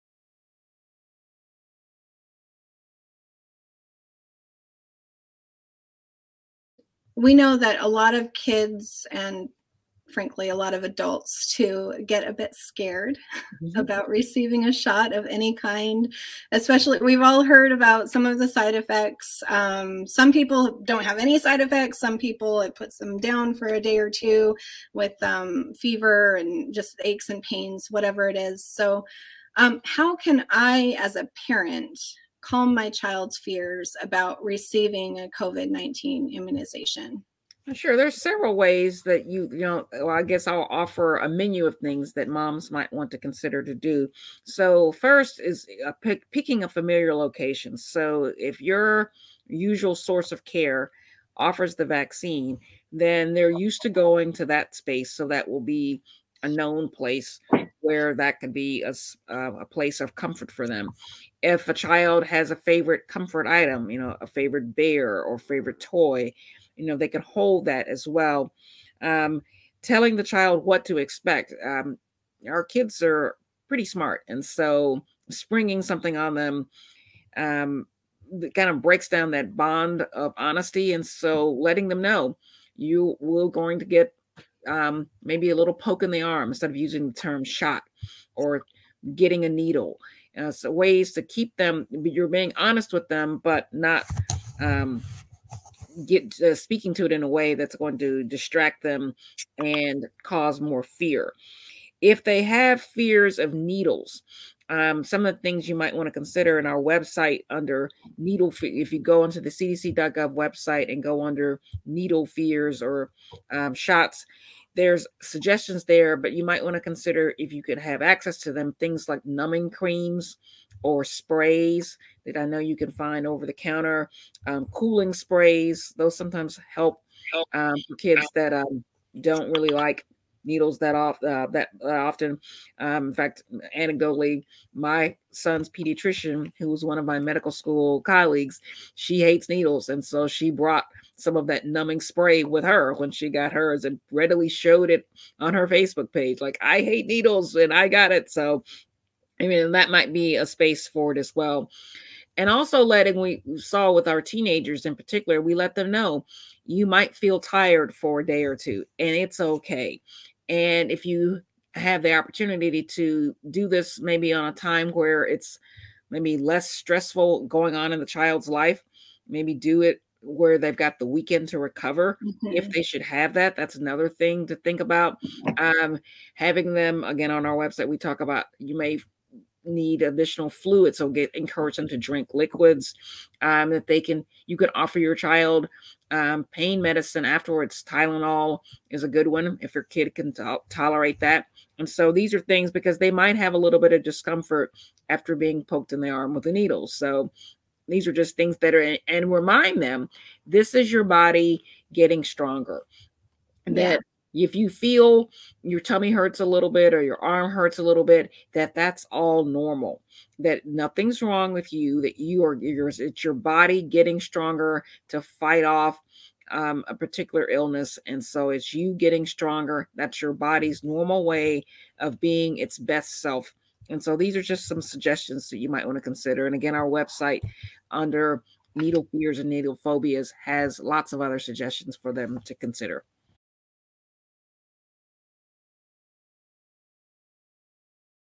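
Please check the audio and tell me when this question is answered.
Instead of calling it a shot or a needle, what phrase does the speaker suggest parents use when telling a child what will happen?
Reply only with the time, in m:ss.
1:25.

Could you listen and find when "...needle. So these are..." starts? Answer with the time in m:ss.
3:16.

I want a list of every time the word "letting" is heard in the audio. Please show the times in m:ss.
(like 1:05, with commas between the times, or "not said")
1:21, 2:32.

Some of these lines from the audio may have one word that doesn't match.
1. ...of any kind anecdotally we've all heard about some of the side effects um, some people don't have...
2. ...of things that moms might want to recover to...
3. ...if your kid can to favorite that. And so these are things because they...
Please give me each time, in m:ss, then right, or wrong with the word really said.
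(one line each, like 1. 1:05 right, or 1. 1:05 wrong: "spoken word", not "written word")
1. 0:15 wrong: "especially", not "anecdotally"
2. 0:41 wrong: "consider", not "recover"
3. 3:09 wrong: "tolerate", not "favorite".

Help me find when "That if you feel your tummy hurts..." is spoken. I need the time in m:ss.
3:23.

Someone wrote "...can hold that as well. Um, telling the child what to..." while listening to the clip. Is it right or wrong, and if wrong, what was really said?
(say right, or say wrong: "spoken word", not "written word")
right.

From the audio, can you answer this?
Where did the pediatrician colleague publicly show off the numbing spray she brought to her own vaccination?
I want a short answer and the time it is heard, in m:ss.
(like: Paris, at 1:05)
Facebook, at 2:25.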